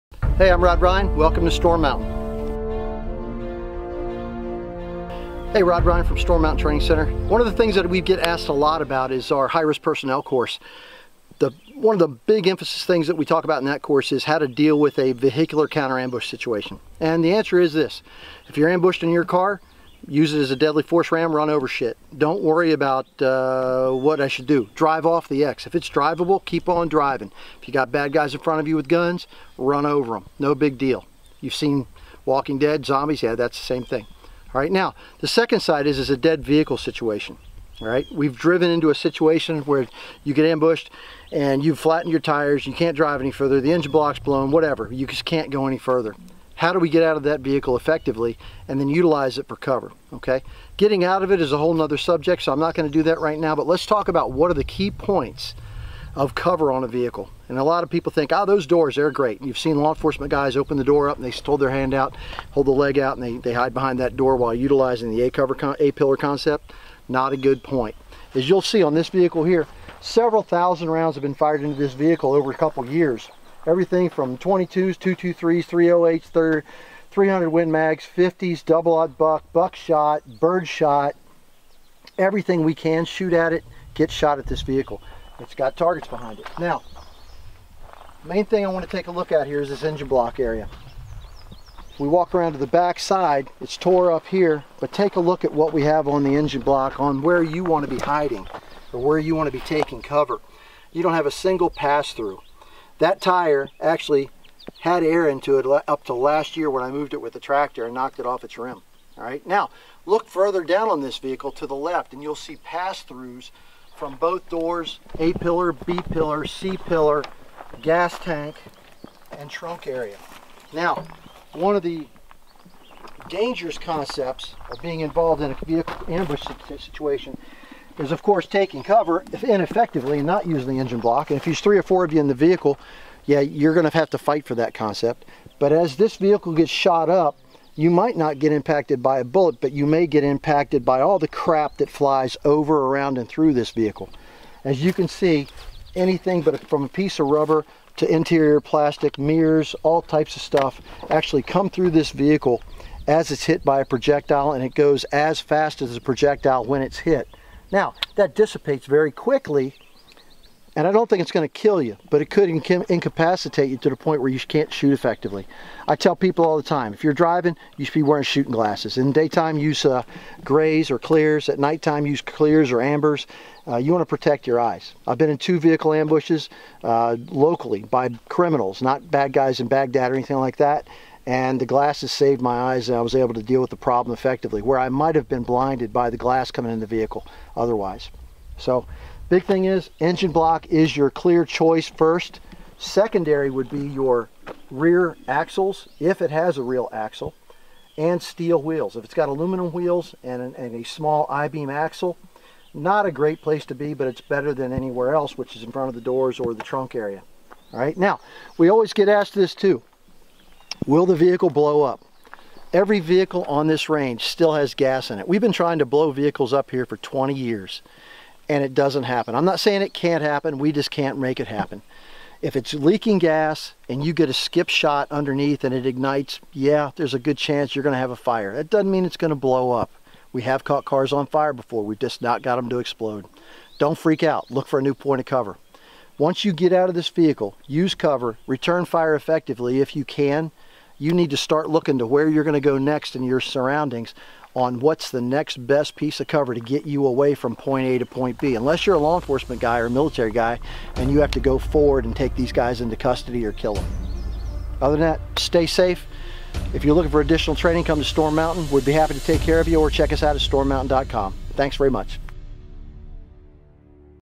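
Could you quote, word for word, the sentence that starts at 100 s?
You don't have a single pass through.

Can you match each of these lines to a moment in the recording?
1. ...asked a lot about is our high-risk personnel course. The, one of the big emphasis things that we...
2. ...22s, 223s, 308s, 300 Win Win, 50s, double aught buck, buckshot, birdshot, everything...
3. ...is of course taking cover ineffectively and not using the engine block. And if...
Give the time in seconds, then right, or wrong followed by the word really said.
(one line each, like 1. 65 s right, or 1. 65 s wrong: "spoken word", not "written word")
1. 8 s right
2. 74 s wrong: "Mags", not "Win"
3. 127 s right.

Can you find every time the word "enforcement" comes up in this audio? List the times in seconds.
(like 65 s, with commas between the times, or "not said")
59 s, 249 s.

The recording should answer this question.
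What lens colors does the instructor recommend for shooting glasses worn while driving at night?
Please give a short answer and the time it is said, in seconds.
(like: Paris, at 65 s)
Clears or ambers, at 172 s.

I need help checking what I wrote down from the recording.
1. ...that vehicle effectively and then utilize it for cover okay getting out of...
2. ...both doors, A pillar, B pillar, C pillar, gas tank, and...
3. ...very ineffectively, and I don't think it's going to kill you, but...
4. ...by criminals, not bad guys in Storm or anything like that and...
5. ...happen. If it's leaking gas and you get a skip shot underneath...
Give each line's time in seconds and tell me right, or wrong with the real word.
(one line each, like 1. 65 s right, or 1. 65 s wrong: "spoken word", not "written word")
1. 47 s right
2. 114 s right
3. 158 s wrong: "quickly", not "ineffectively"
4. 177 s wrong: "Baghdad", not "Storm"
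5. 221 s right.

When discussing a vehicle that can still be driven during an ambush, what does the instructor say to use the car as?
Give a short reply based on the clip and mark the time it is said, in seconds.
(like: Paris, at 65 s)
A deadly force ram, at 20 s.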